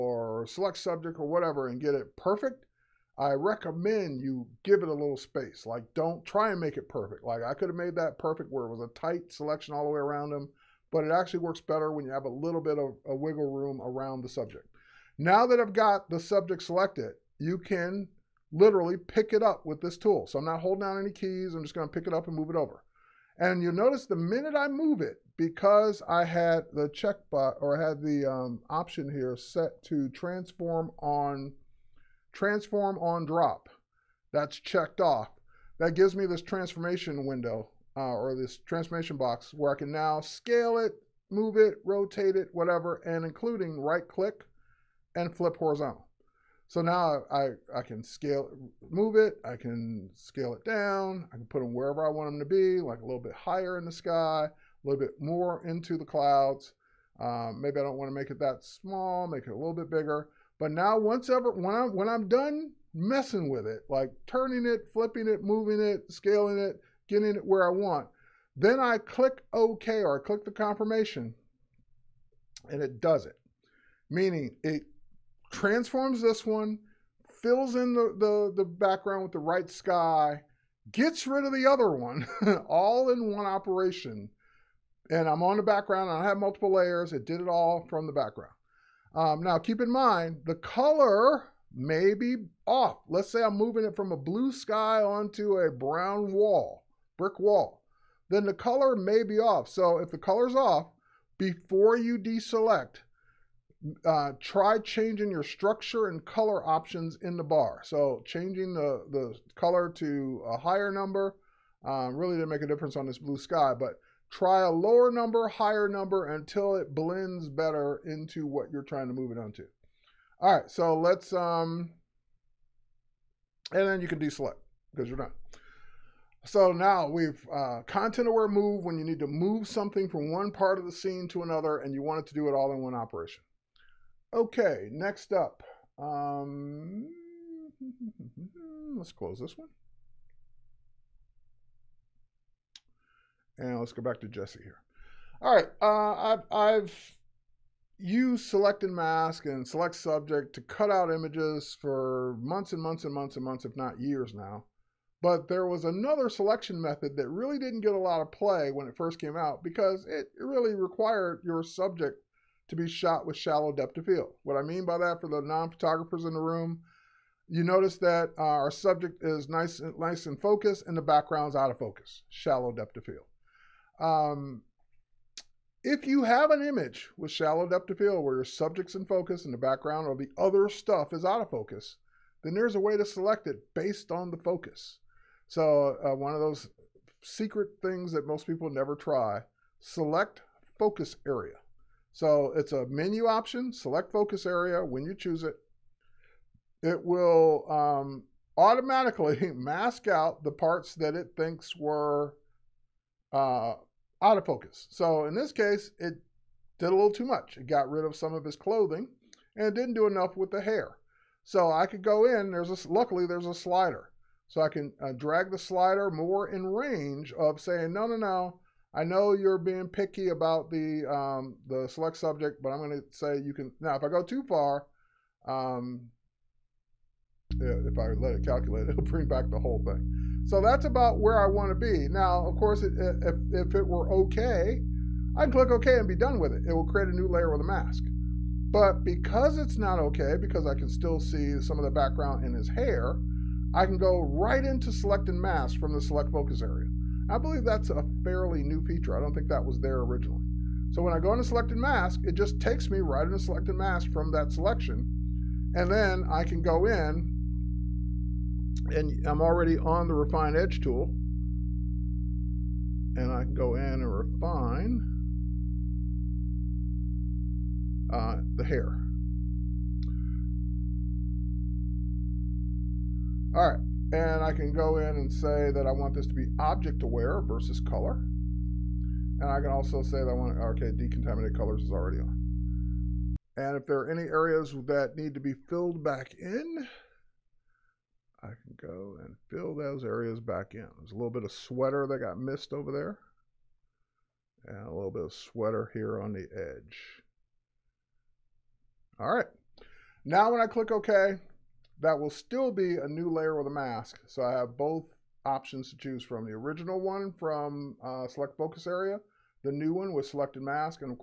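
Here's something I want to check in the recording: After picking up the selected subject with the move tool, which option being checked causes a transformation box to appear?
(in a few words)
Transform on drop.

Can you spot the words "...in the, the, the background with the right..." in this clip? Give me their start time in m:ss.
1:17.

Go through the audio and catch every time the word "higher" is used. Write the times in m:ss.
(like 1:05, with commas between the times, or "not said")
0:53, 1:50, 1:55.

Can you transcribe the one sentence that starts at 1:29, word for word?
Um, now keep in mind, the color may be off.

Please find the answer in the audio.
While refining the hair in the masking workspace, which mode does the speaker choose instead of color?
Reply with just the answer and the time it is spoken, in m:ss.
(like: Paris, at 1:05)
Object aware, at 4:36.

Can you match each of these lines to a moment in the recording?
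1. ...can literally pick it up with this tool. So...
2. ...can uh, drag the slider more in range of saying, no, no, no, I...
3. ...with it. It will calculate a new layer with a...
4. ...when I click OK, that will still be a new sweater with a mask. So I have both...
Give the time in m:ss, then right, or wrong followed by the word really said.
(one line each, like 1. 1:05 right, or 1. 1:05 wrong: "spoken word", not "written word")
1. 0:17 right
2. 3:34 right
3. 3:56 wrong: "create", not "calculate"
4. 5:00 wrong: "layer", not "sweater".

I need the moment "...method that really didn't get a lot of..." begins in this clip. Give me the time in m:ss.
2:36.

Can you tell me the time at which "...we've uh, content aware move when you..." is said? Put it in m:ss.
2:07.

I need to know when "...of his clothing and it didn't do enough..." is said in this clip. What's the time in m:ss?
3:28.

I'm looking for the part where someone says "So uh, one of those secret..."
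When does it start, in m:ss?
3:05.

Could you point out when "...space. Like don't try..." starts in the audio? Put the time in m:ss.
0:05.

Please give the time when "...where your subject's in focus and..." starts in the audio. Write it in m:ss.
2:58.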